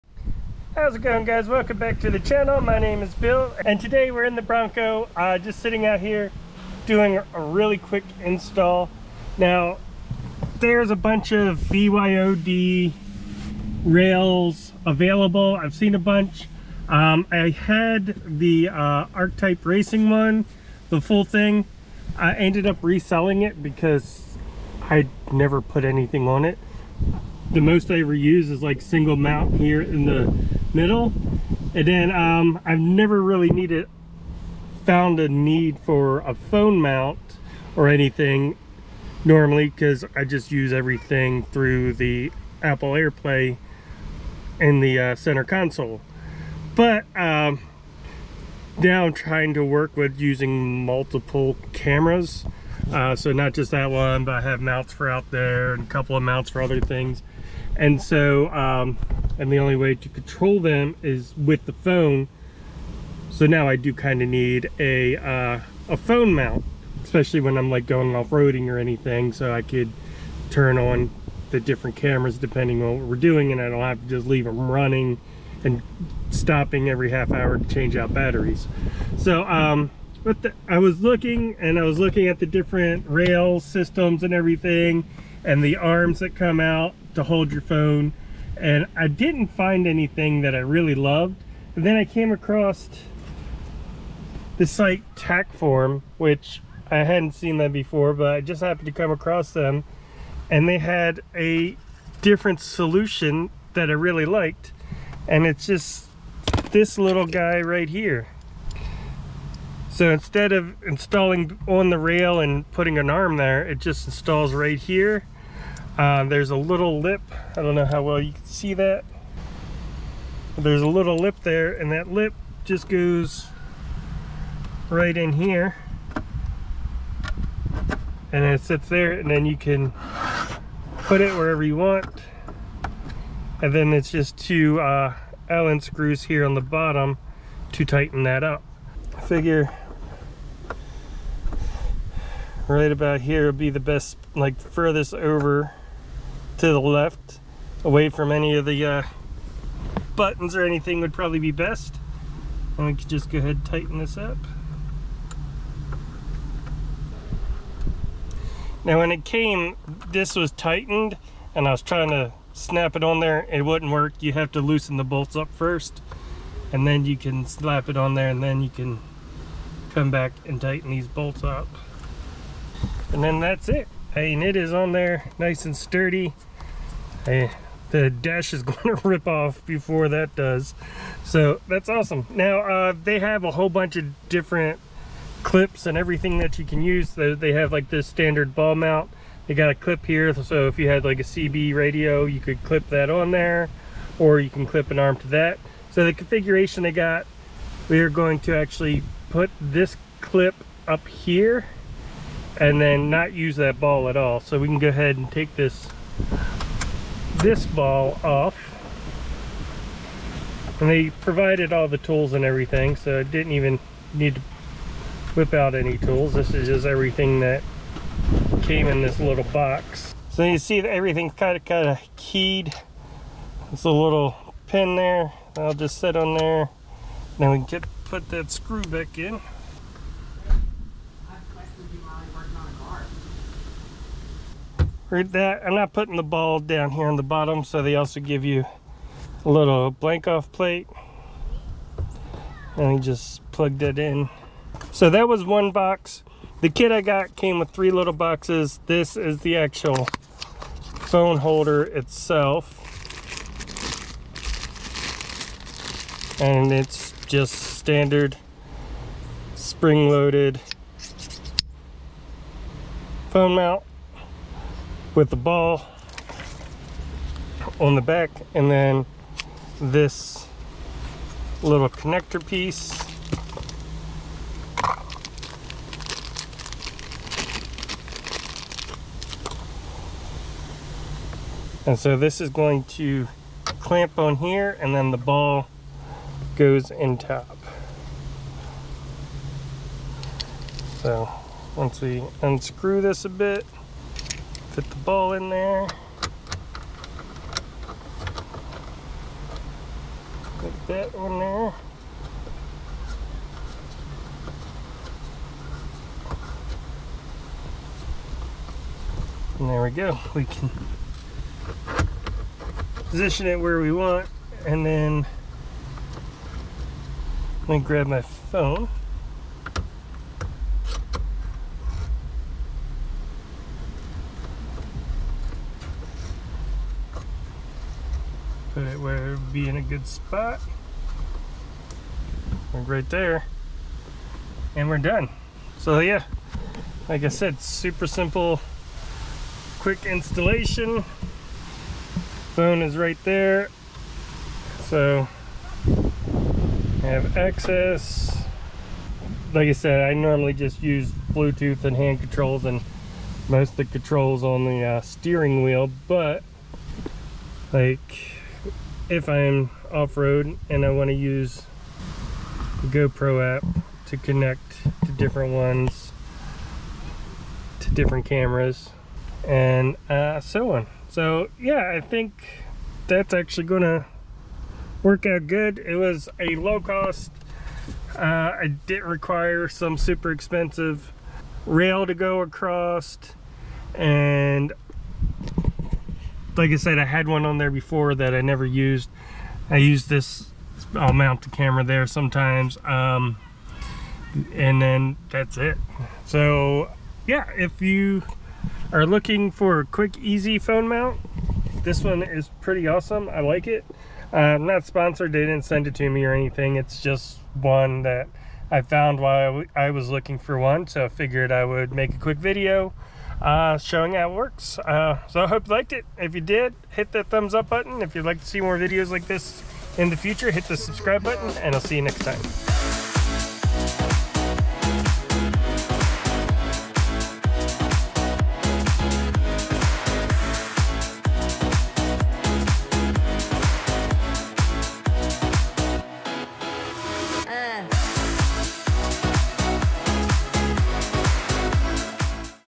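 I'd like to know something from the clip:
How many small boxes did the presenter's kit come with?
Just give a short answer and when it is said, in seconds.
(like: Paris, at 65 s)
3, at 247 s.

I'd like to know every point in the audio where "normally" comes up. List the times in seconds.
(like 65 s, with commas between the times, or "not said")
39 s, 350 s.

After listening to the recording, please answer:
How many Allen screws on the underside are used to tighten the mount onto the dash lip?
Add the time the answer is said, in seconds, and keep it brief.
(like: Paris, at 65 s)
2, at 134 s.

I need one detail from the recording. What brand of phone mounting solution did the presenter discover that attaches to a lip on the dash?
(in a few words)
Tackform.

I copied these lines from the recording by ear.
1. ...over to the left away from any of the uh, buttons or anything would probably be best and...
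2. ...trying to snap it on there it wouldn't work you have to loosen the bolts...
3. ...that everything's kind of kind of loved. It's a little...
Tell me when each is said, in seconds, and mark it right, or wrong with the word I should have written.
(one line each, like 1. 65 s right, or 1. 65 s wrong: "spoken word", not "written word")
1. 145 s right
2. 161 s right
3. 220 s wrong: "keyed", not "loved".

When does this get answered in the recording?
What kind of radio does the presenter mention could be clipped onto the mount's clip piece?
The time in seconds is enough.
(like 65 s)
191 s.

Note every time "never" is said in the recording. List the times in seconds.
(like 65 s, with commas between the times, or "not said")
25 s, 32 s, 388 s.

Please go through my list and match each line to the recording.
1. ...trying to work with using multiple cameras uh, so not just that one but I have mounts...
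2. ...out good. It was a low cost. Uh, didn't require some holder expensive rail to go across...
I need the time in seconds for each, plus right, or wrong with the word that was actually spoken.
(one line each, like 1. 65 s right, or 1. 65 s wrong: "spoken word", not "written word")
1. 49 s right
2. 375 s wrong: "super", not "holder".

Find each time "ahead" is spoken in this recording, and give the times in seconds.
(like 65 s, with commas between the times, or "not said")
153 s, 204 s.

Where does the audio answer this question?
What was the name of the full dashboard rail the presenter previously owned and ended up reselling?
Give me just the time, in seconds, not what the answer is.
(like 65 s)
19 s.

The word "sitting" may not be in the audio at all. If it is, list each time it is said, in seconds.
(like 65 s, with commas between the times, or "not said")
5 s.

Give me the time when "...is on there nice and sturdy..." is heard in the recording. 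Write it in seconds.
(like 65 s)
174 s.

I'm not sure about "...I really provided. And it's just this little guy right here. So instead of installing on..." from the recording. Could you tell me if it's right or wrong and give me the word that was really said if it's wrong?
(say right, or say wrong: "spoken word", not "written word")
wrong: "liked", not "provided".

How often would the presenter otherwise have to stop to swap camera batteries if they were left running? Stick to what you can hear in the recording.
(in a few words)
every half hour.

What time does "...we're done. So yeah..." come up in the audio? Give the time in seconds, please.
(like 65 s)
334 s.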